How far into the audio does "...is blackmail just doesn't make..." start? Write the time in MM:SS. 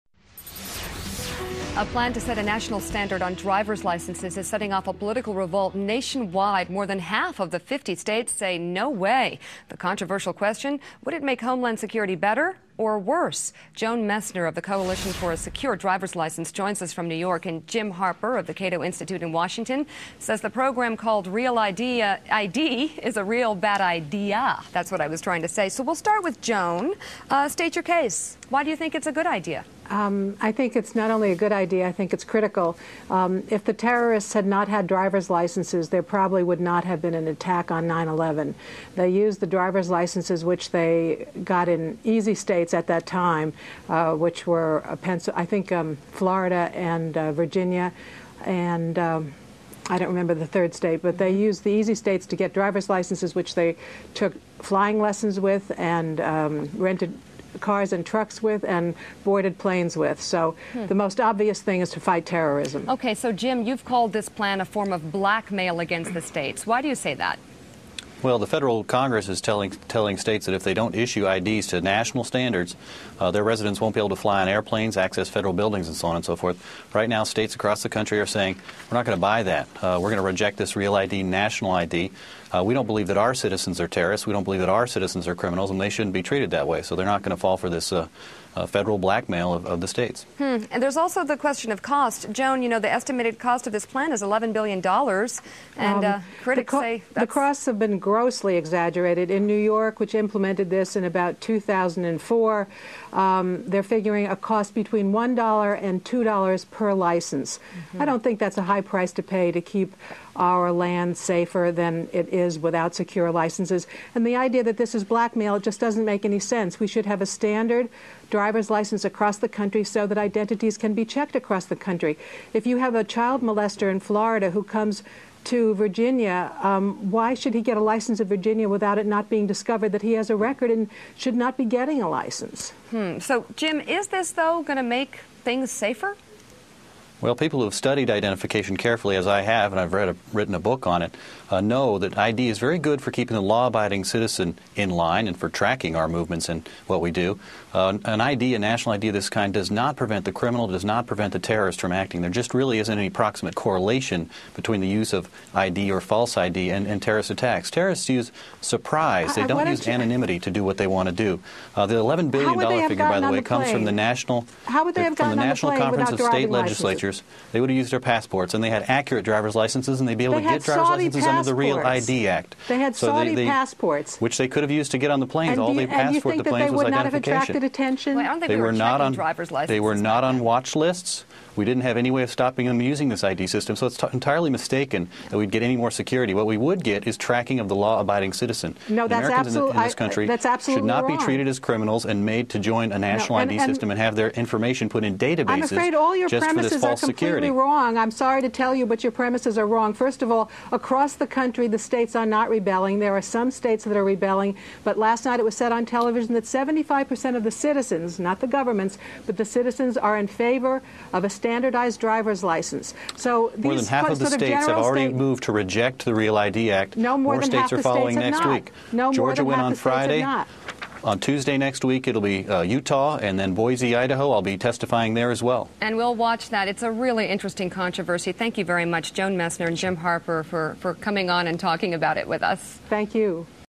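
01:54.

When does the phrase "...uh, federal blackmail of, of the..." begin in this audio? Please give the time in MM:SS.
01:28.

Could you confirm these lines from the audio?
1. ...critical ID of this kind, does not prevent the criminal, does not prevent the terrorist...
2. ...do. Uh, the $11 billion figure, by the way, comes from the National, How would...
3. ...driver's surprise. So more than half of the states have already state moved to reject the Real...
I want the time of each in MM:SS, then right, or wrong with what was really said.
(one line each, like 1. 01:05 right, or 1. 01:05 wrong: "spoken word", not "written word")
1. 02:28 wrong: "national", not "critical"
2. 02:41 right
3. 03:31 wrong: "license", not "surprise".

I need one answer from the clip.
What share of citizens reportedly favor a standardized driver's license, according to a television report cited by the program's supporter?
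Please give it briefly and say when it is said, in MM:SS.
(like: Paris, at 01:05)
75%, at 03:26.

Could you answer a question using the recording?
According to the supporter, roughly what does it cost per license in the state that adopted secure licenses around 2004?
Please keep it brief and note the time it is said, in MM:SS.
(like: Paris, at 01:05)
$1 to $2, at 01:44.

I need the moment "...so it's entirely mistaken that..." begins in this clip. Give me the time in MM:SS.
03:03.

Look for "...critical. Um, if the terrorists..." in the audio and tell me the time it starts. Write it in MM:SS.
00:32.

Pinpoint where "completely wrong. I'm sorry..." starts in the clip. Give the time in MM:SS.
03:17.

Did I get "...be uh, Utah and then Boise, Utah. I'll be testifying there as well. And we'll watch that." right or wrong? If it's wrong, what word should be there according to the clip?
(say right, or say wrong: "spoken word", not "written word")
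wrong: "Idaho", not "Utah".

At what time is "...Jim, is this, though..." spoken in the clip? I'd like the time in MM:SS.
02:13.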